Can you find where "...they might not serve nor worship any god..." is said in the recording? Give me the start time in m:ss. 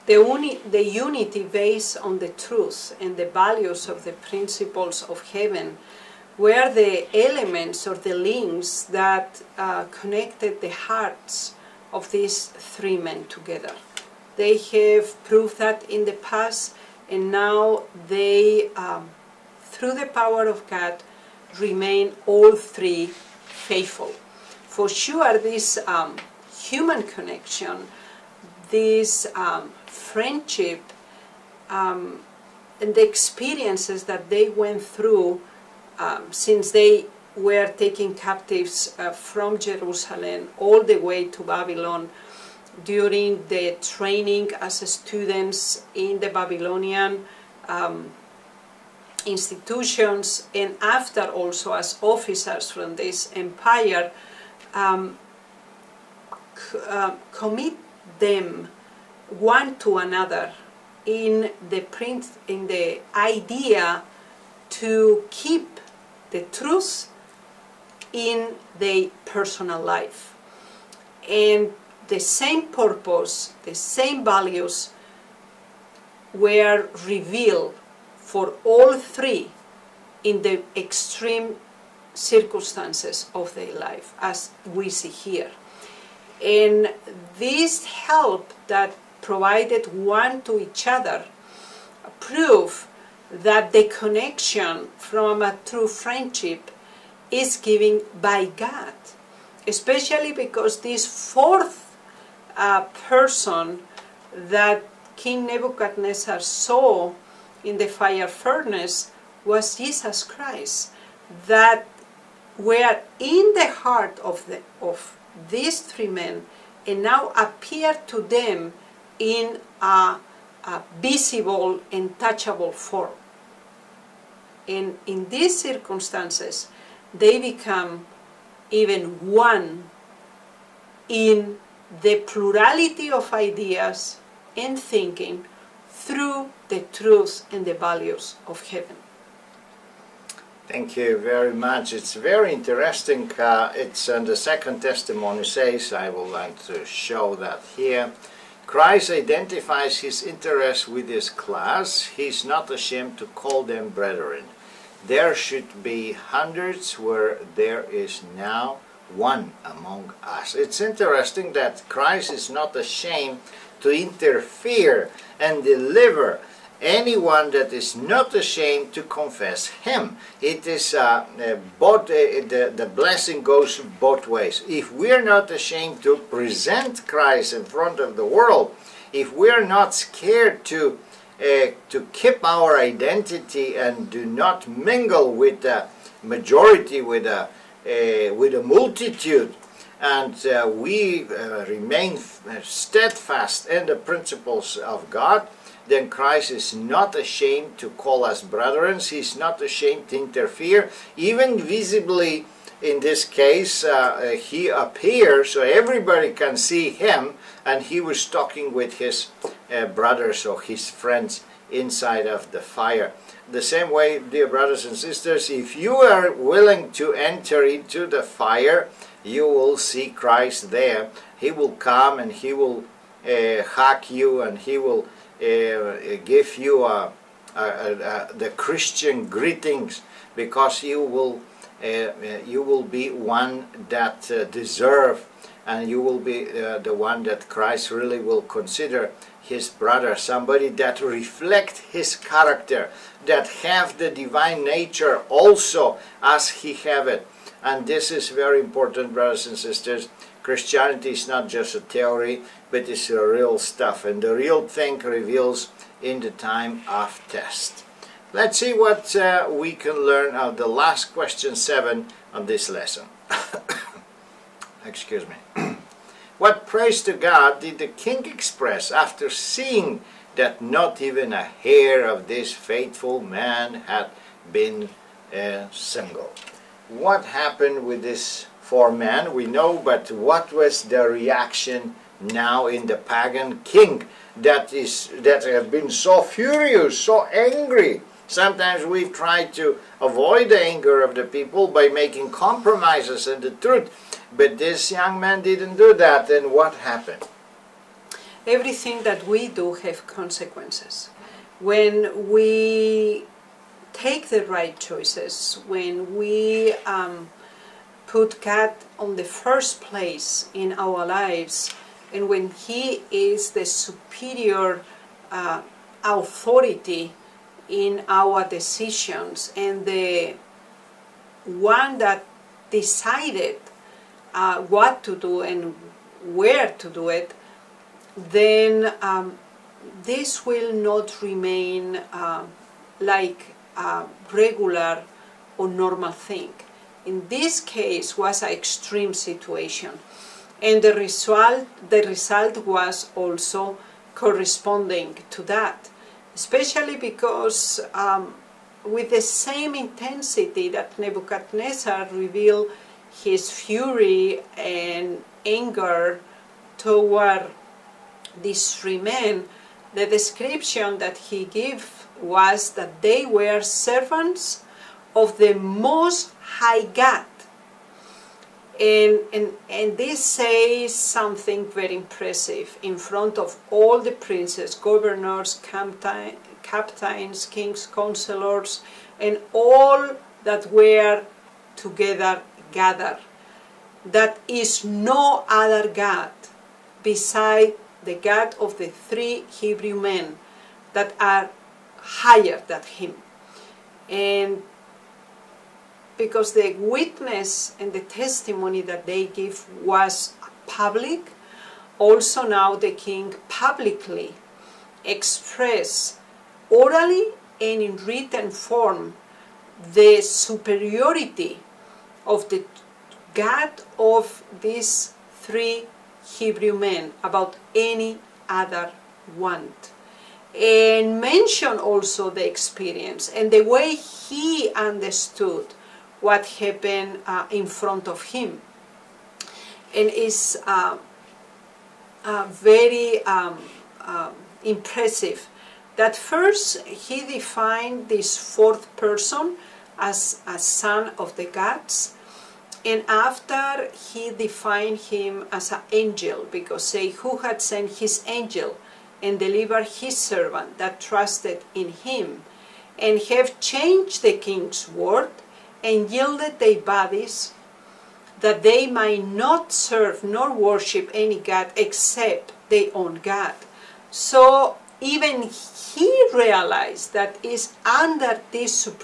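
7:38.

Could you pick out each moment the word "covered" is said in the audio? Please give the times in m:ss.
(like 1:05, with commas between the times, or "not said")
not said.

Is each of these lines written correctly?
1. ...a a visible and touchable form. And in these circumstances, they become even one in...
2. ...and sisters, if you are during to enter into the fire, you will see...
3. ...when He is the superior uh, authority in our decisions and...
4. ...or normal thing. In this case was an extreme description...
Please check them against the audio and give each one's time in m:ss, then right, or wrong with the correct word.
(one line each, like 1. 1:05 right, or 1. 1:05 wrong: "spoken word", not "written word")
1. 1:59 right
2. 3:34 wrong: "willing", not "during"
3. 5:12 right
4. 5:35 wrong: "situation", not "description".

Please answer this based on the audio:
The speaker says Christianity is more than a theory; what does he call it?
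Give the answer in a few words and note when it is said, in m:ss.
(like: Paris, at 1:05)
a real stuff, at 4:13.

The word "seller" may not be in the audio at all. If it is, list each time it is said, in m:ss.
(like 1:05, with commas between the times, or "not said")
not said.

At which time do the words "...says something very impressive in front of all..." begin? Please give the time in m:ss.
6:10.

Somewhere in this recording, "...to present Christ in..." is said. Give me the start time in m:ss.
2:56.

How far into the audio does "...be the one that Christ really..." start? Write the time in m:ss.
3:56.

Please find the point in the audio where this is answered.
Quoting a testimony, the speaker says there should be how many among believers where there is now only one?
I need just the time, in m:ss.
2:36.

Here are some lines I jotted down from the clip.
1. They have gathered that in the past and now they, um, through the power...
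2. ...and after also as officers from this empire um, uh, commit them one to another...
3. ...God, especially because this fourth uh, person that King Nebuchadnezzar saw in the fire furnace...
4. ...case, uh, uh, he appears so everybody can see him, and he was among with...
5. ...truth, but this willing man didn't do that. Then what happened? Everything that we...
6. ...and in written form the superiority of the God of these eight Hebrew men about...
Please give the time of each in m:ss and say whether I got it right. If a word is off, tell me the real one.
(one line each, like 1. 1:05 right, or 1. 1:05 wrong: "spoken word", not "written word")
1. 0:14 wrong: "proved", not "gathered"
2. 0:50 right
3. 1:38 right
4. 3:23 wrong: "talking", not "among"
5. 4:53 wrong: "young", not "willing"
6. 6:47 wrong: "three", not "eight".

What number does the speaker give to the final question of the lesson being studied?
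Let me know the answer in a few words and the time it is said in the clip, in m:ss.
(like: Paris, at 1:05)
7, at 4:21.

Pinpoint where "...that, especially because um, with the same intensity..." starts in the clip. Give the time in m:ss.
5:45.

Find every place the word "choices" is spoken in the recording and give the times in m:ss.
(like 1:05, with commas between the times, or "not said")
5:04.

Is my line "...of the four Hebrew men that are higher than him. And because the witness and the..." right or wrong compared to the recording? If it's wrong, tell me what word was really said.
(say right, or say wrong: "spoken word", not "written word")
wrong: "three", not "four".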